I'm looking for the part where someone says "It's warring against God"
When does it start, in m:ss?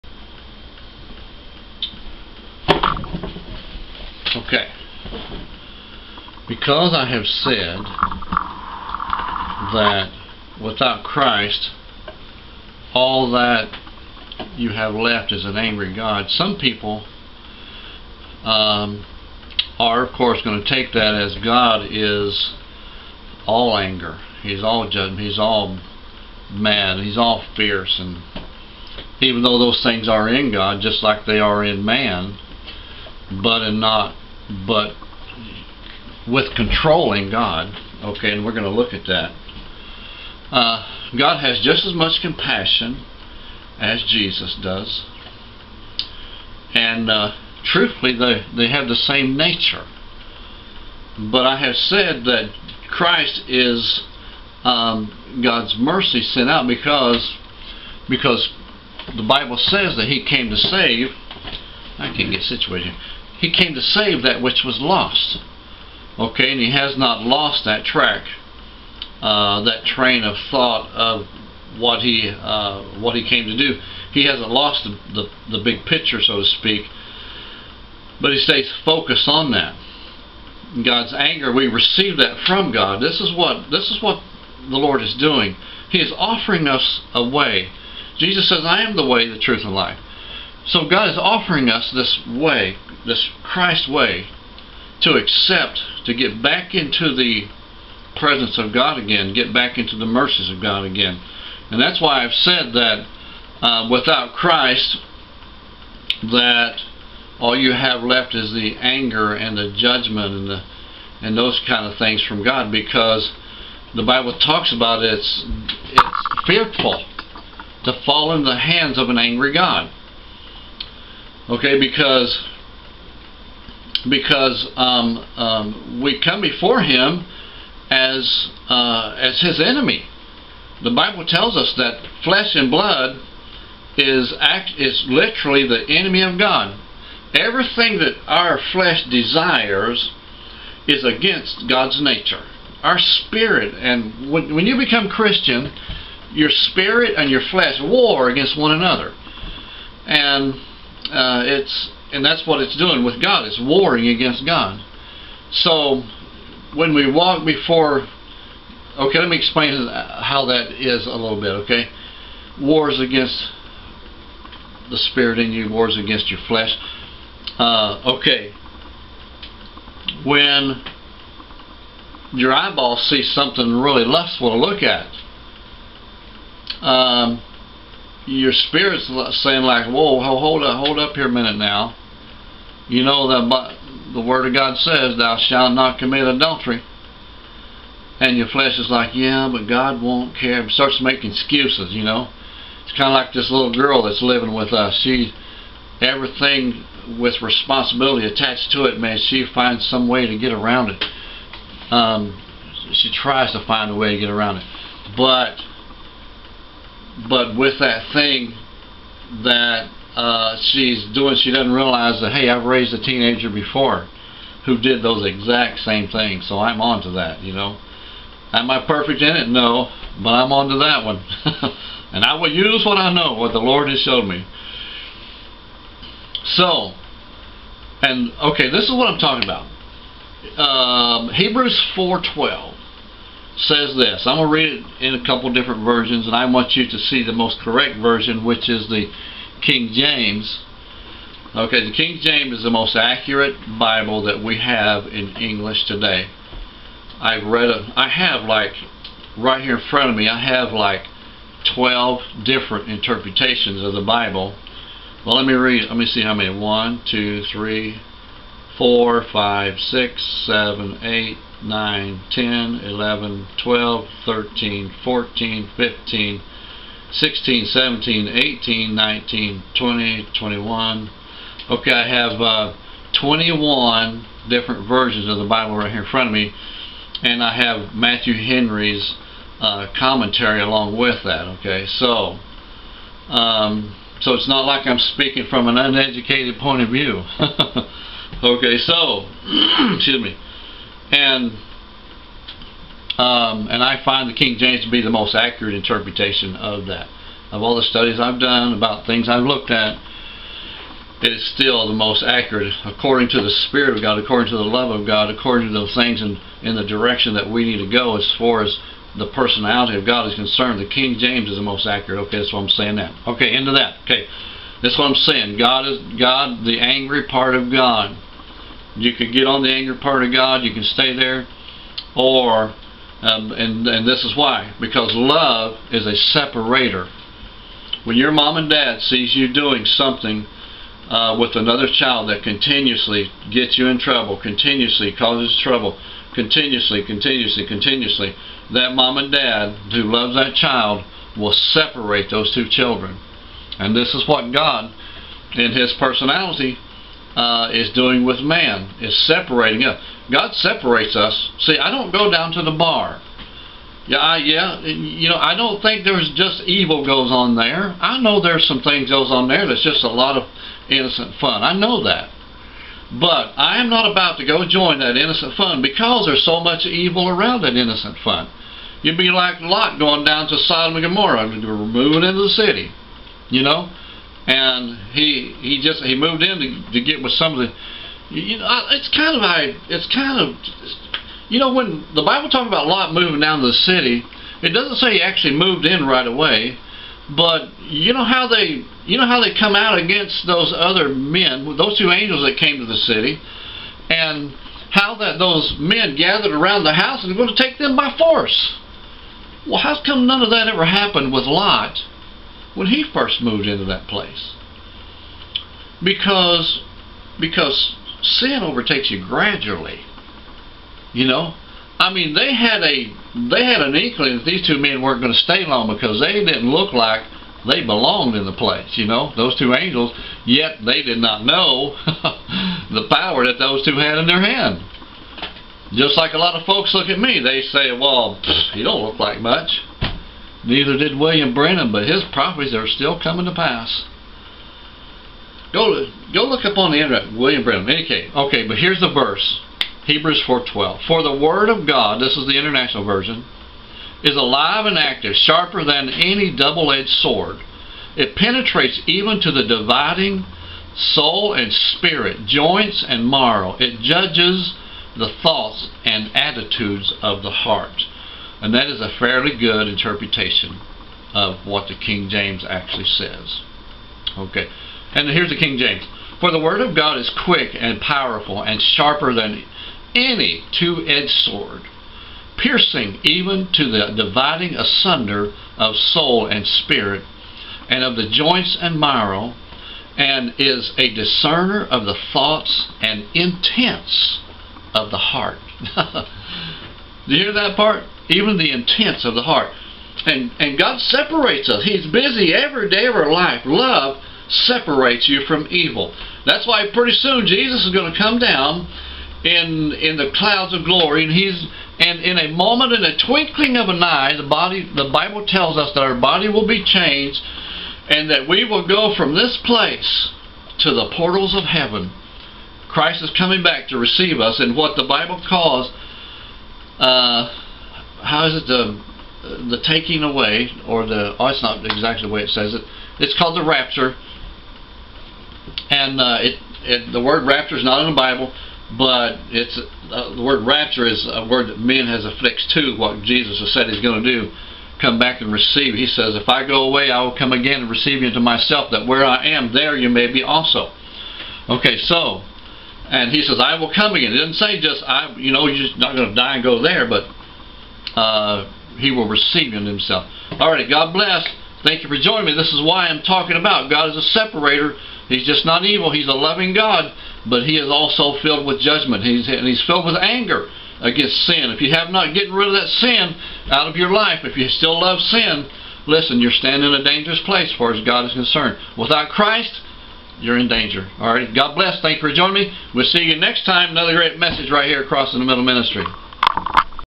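2:33.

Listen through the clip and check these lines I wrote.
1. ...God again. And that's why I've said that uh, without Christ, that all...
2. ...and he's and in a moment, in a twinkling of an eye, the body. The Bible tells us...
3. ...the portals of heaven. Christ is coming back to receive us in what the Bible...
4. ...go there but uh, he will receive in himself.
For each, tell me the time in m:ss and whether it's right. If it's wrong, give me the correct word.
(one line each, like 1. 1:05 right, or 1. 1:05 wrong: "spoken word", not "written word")
1. 1:40 right
2. 8:21 right
3. 8:30 right
4. 9:06 right.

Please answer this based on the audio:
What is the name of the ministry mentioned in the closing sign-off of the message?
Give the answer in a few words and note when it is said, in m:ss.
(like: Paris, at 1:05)
Across in the Middle Ministry, at 9:35.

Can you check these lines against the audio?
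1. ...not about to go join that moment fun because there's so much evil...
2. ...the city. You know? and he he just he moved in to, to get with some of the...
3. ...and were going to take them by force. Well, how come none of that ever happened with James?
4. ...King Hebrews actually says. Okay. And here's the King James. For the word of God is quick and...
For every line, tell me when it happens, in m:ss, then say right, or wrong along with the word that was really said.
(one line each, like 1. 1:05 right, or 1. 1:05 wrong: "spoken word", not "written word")
1. 6:03 wrong: "innocent", not "moment"
2. 6:12 right
3. 6:37 wrong: "Lot", not "James"
4. 7:41 wrong: "James", not "Hebrews".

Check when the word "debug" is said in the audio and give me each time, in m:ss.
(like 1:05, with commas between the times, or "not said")
not said.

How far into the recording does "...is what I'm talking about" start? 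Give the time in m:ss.
3:48.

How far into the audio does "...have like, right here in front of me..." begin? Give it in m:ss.
4:08.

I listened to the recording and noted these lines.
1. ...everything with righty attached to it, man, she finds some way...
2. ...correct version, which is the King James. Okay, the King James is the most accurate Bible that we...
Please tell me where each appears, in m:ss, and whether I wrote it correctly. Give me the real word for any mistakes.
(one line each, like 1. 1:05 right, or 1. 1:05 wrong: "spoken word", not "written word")
1. 3:16 wrong: "responsibility", not "righty"
2. 3:57 right.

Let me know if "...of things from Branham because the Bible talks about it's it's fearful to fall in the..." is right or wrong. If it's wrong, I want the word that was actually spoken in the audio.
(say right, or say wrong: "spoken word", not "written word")
wrong: "God", not "Branham".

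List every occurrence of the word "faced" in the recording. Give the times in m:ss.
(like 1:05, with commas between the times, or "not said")
not said.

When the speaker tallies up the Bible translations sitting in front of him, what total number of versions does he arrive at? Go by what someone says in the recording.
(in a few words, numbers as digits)
21.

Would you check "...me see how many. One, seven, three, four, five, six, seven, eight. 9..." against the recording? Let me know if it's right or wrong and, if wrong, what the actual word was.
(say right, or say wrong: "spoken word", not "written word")
wrong: "two", not "seven".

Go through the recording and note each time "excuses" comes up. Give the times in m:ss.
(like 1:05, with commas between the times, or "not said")
3:11, 4:49.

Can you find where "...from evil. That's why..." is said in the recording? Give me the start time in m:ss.
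8:15.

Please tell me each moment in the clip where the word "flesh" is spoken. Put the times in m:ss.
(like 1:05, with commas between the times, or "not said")
2:12, 2:18, 2:27, 2:46, 3:08.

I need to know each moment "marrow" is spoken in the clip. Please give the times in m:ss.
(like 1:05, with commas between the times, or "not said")
7:33, 7:58.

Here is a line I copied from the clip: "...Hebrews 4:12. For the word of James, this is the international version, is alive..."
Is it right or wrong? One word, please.
wrong.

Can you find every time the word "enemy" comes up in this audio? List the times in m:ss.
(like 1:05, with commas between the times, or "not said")
2:09, 2:15.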